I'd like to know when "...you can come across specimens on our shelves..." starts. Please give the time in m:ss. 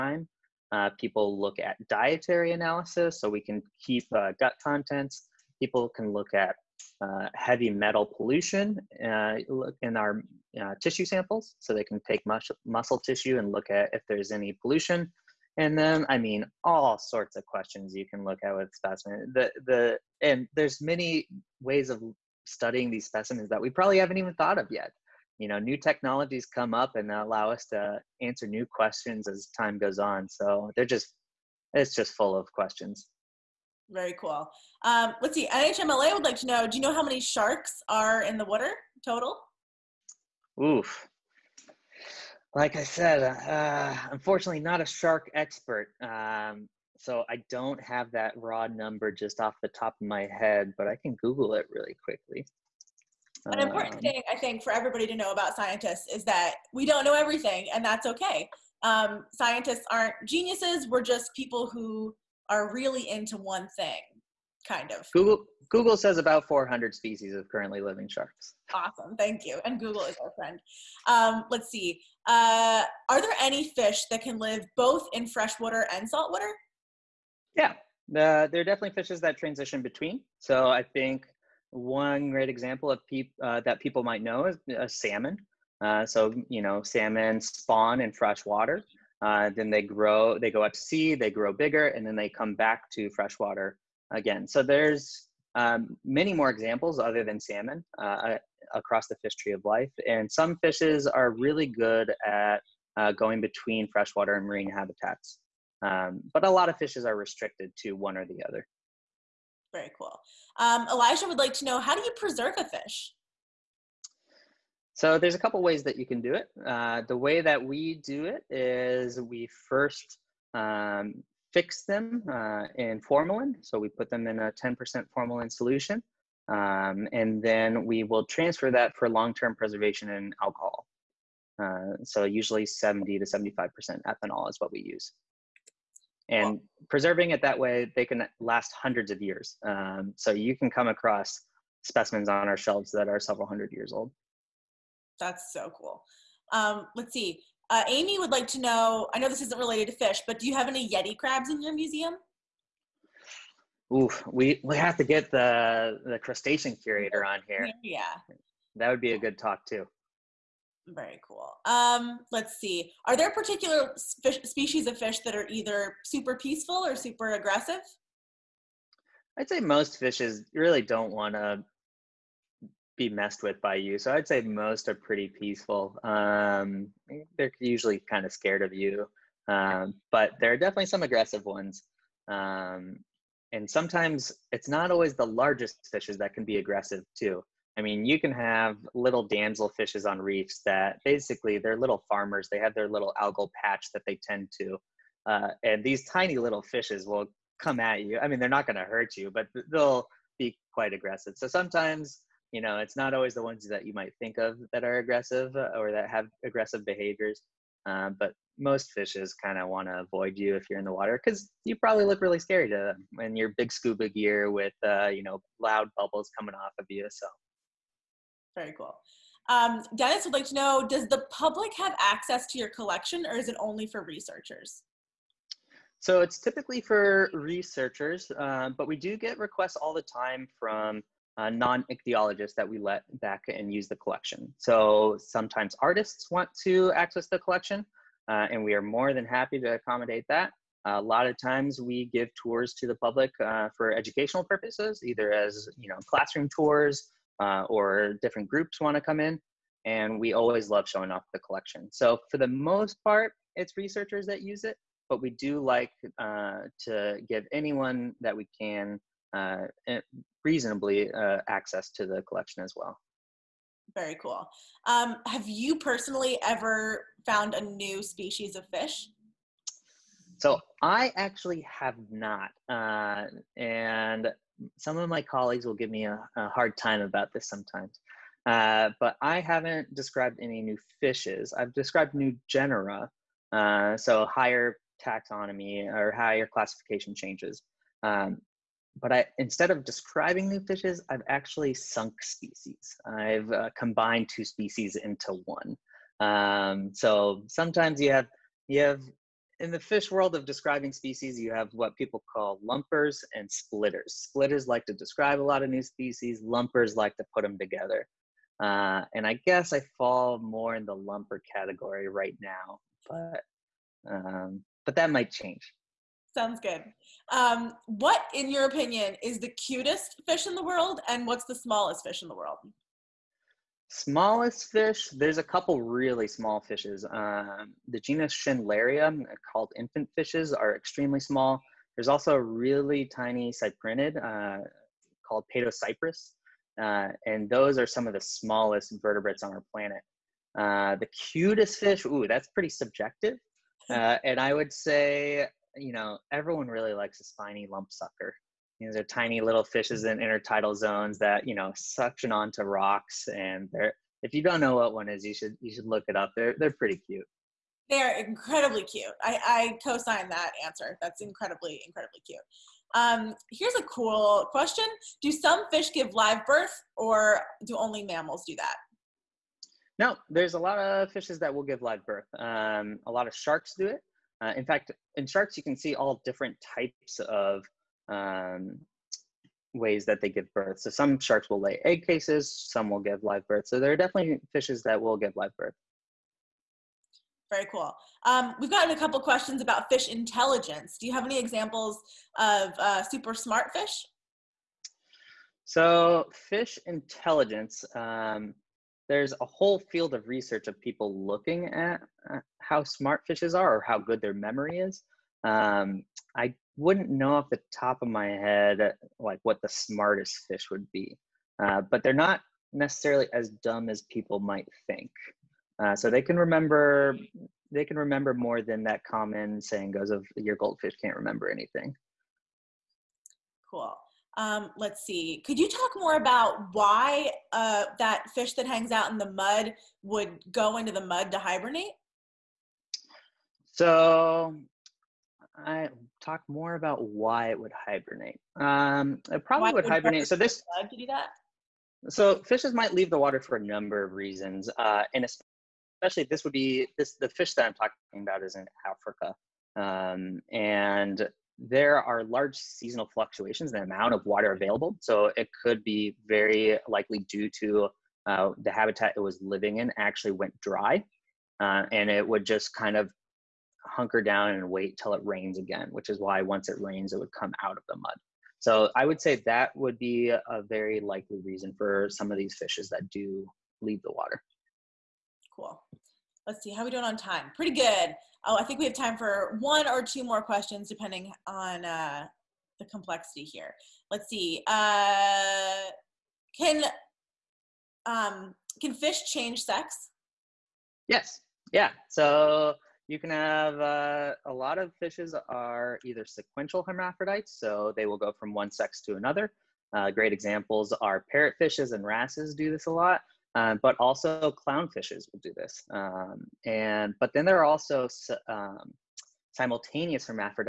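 2:20.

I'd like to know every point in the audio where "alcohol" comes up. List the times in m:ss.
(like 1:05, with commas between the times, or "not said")
2:10.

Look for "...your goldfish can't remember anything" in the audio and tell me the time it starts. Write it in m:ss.
7:00.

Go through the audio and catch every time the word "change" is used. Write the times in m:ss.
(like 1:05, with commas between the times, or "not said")
4:47, 5:15, 8:09.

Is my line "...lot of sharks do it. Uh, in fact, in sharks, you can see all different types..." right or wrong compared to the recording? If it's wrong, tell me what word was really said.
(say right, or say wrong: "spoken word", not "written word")
right.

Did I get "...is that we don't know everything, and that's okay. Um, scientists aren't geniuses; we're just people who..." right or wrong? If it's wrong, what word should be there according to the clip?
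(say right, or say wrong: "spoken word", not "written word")
right.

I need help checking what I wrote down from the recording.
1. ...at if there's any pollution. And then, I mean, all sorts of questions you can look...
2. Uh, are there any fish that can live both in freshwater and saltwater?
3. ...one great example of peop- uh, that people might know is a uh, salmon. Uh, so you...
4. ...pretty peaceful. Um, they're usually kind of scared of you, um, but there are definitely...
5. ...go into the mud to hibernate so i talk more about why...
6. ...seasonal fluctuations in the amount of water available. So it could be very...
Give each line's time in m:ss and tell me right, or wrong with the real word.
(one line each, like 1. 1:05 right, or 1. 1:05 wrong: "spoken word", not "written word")
1. 0:13 right
2. 1:12 right
3. 1:21 right
4. 2:54 right
5. 7:10 right
6. 7:32 right.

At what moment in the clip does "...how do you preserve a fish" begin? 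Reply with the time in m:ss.
1:51.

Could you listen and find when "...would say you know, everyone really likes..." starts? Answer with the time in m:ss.
5:44.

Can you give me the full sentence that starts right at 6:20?
So some sharks will lay egg cases, some will give live birth.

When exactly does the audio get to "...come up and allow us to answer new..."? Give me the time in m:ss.
0:26.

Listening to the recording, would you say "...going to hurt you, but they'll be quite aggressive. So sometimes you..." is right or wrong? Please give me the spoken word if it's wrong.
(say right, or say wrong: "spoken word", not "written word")
right.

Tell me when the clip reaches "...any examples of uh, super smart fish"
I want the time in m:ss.
6:31.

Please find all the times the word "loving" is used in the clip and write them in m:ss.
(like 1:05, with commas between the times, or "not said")
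not said.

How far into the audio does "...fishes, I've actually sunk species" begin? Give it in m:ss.
4:50.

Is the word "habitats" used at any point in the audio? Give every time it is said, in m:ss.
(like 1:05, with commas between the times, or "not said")
1:44, 7:38.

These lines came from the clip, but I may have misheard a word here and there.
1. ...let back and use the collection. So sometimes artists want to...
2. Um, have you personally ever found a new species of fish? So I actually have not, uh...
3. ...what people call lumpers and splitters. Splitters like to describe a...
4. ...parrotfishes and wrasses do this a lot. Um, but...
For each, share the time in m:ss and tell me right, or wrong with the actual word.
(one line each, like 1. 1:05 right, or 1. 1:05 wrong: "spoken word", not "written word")
1. 3:52 right
2. 4:24 right
3. 5:01 right
4. 8:21 right.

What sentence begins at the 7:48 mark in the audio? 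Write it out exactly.
So I would say that would be a very likely reason for some of these fishes that do leave the water.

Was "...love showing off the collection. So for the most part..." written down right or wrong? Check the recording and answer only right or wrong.
right.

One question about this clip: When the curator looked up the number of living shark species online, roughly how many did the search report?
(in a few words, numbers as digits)
400.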